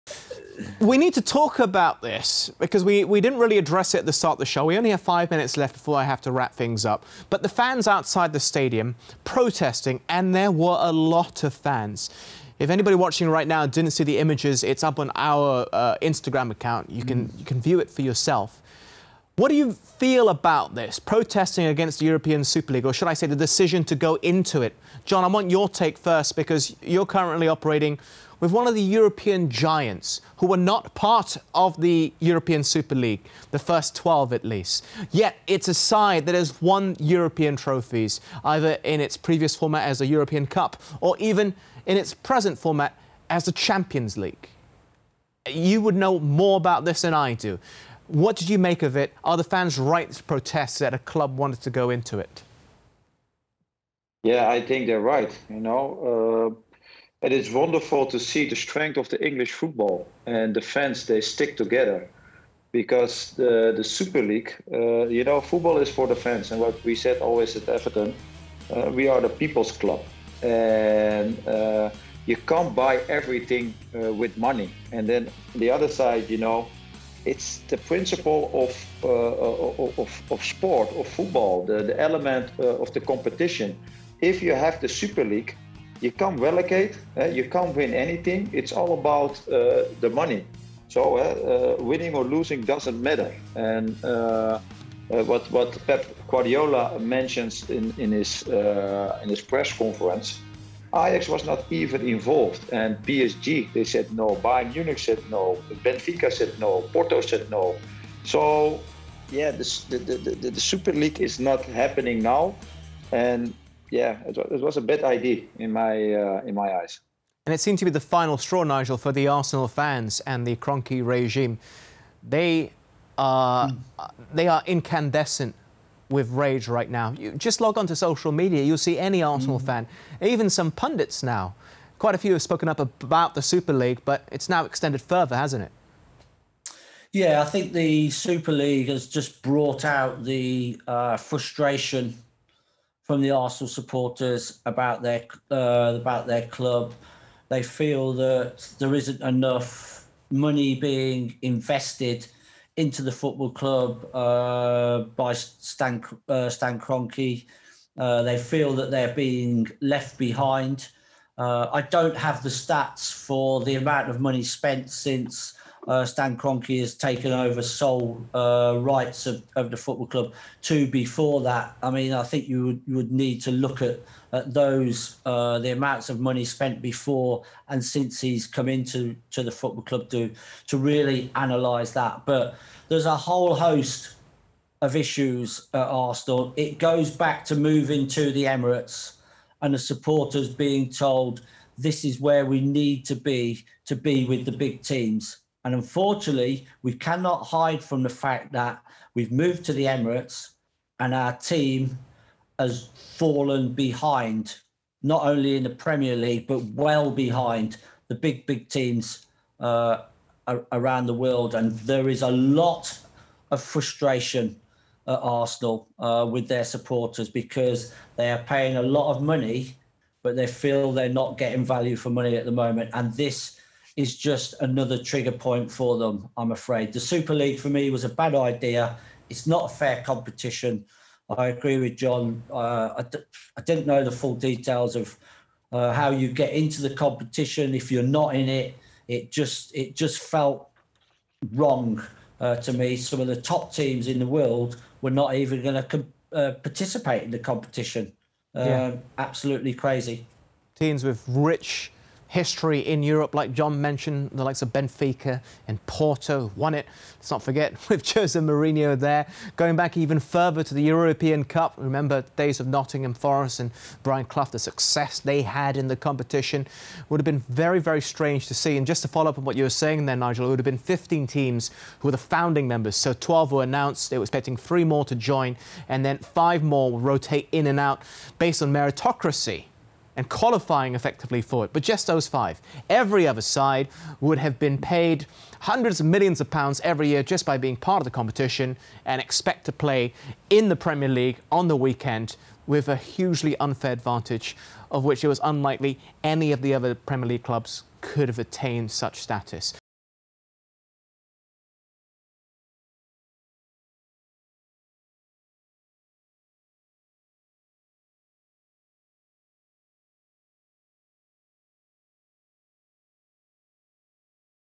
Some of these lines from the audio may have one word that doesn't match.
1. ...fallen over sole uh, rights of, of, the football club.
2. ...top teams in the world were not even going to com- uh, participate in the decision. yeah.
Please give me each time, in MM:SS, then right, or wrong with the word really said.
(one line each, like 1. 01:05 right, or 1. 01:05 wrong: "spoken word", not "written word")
1. 02:46 wrong: "taken", not "fallen"
2. 04:03 wrong: "competition", not "decision".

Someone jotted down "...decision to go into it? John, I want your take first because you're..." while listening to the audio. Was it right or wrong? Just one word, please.
right.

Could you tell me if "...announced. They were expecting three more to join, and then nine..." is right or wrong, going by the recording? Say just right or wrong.
wrong.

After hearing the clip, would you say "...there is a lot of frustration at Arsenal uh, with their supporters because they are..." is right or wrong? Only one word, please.
right.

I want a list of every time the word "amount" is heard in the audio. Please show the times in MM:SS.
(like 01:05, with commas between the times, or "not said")
02:43, 02:55.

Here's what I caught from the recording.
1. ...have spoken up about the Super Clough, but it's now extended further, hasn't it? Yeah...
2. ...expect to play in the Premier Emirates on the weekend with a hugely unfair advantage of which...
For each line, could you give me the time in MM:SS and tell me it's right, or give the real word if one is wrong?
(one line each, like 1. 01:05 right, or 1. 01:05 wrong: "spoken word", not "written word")
1. 02:12 wrong: "League", not "Clough"
2. 04:49 wrong: "League", not "Emirates".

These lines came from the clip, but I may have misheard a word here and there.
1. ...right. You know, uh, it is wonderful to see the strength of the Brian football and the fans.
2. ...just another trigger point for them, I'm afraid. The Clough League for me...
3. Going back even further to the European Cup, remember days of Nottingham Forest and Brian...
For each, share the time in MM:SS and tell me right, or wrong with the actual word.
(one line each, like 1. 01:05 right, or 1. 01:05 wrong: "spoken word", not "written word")
1. 00:54 wrong: "English", not "Brian"
2. 03:44 wrong: "Super", not "Clough"
3. 04:19 right.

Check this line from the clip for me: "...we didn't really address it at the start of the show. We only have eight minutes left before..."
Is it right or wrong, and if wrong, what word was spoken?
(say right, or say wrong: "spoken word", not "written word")
wrong: "five", not "eight".